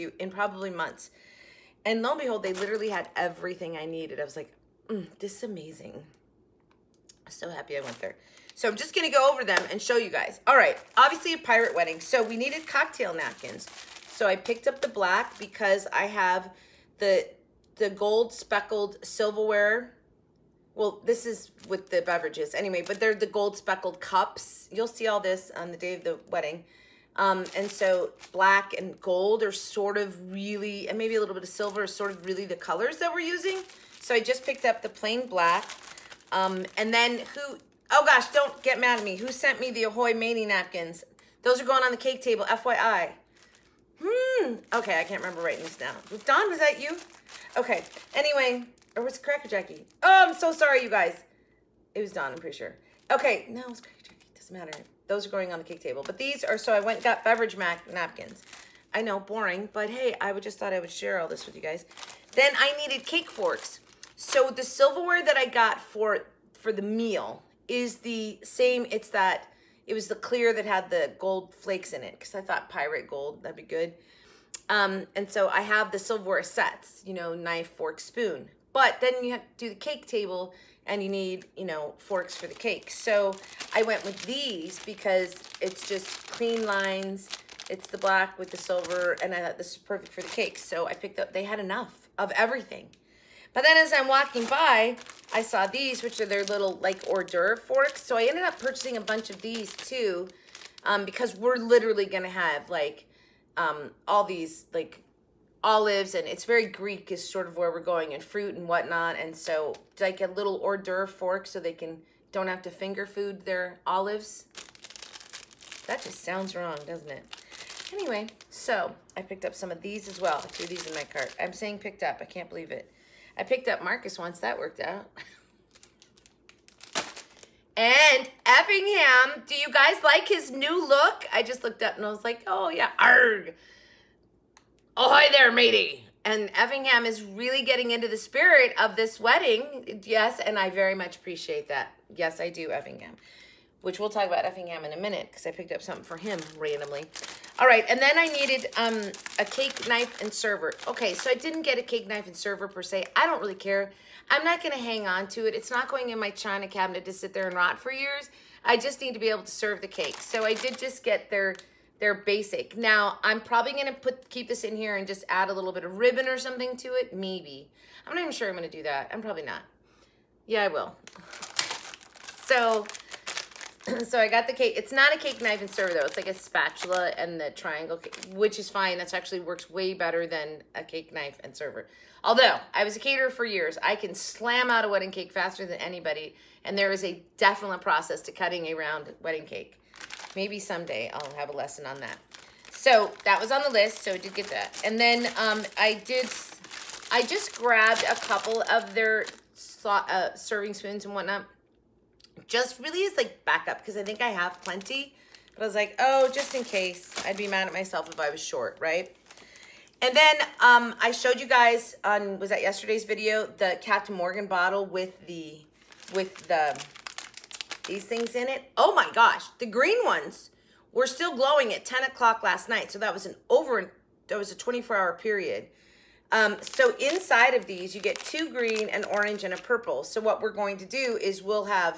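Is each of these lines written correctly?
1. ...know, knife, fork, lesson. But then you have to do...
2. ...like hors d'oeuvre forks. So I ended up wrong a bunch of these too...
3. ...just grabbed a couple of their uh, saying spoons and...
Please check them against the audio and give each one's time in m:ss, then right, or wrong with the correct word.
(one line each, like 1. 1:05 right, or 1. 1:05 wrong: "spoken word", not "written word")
1. 1:17 wrong: "spoon", not "lesson"
2. 1:36 wrong: "purchasing", not "wrong"
3. 3:17 wrong: "serving", not "saying".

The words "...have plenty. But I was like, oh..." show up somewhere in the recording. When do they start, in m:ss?
3:24.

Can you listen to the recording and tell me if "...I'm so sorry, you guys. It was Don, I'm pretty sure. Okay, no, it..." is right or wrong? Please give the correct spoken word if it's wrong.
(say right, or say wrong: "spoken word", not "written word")
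right.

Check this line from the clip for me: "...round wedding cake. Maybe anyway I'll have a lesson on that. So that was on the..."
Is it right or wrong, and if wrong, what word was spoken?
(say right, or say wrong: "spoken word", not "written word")
wrong: "someday", not "anyway".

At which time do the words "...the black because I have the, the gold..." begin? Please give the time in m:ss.
0:14.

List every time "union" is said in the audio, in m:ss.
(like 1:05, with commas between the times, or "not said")
not said.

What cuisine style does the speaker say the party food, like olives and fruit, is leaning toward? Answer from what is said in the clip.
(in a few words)
Greek.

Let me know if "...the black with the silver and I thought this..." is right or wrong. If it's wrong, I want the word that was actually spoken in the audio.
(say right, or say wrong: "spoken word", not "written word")
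right.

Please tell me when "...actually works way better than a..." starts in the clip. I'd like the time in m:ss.
2:59.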